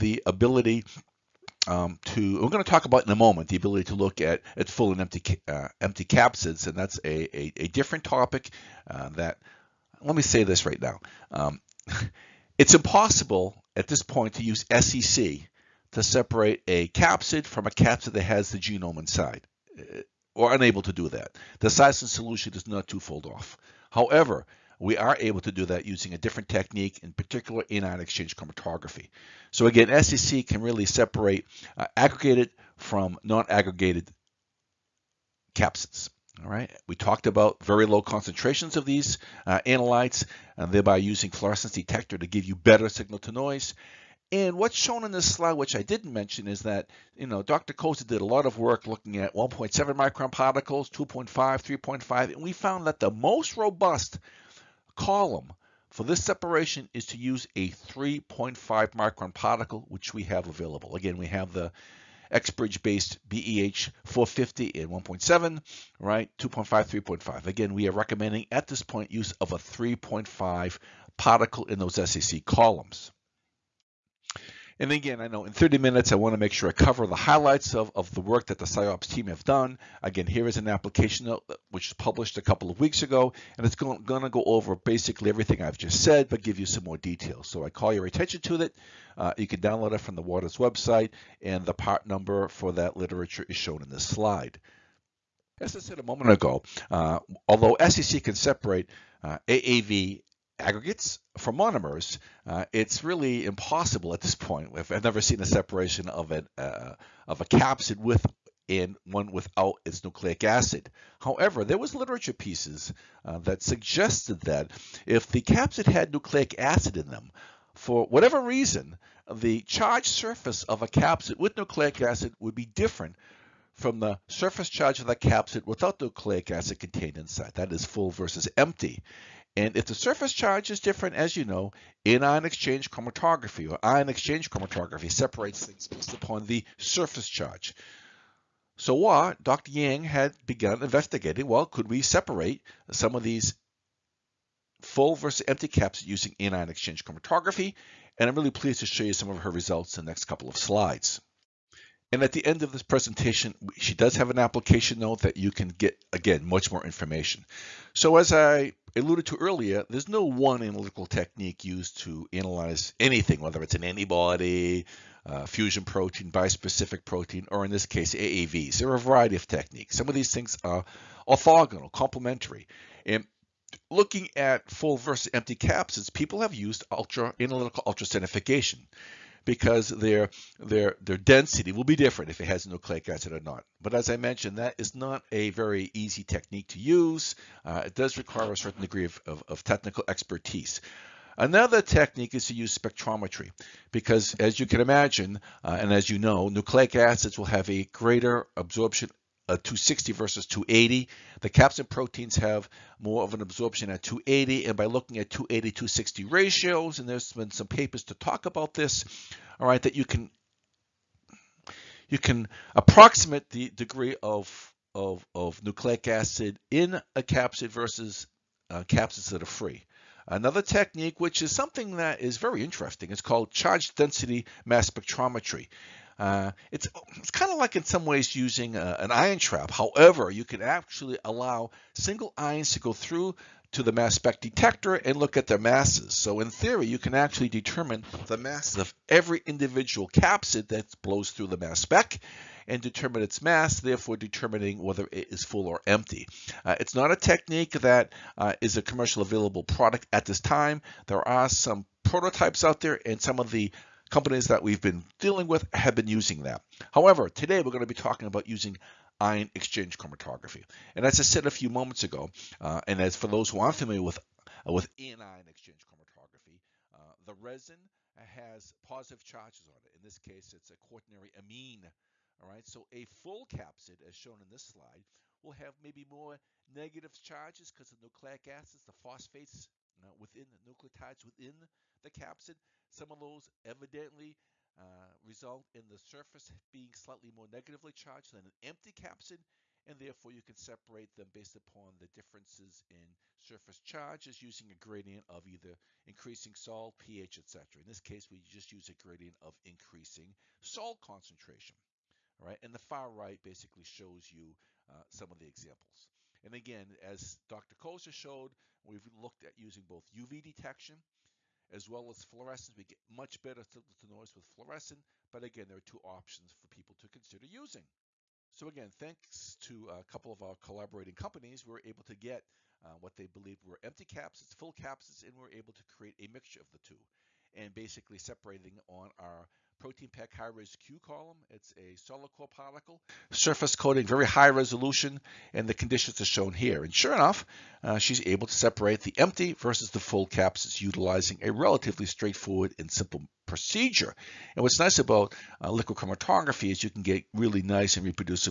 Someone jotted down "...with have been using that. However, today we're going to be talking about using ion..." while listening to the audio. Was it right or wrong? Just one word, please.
right.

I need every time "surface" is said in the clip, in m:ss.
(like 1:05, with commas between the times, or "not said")
2:00, 2:04, 2:09, 2:16, 4:45, 4:53, 5:33.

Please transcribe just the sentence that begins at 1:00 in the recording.
Again, we have the XBridge-based BEH 450 and 1.7, right?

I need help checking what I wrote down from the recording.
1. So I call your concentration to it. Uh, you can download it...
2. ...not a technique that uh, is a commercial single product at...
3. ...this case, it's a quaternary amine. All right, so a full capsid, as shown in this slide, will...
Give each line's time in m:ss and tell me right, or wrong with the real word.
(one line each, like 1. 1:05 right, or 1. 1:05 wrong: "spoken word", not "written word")
1. 1:27 wrong: "attention", not "concentration"
2. 4:06 wrong: "available", not "single"
3. 4:30 right.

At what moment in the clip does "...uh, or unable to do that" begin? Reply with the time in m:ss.
0:19.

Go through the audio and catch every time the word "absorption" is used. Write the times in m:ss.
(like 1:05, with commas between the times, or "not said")
3:18, 3:23.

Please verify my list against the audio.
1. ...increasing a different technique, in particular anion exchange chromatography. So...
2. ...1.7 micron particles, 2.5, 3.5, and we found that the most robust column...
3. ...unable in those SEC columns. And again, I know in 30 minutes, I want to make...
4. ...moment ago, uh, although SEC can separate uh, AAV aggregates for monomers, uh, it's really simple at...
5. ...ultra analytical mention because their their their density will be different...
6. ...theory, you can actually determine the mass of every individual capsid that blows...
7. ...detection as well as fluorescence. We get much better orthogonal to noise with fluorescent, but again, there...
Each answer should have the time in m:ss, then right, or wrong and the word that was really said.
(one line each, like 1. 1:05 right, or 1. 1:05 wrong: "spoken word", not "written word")
1. 0:25 wrong: "using", not "increasing"
2. 0:49 right
3. 1:11 wrong: "particle", not "unable"
4. 1:36 wrong: "impossible", not "simple"
5. 2:56 wrong: "ultracentrifugation", not "mention"
6. 3:56 right
7. 5:10 wrong: "signal", not "orthogonal".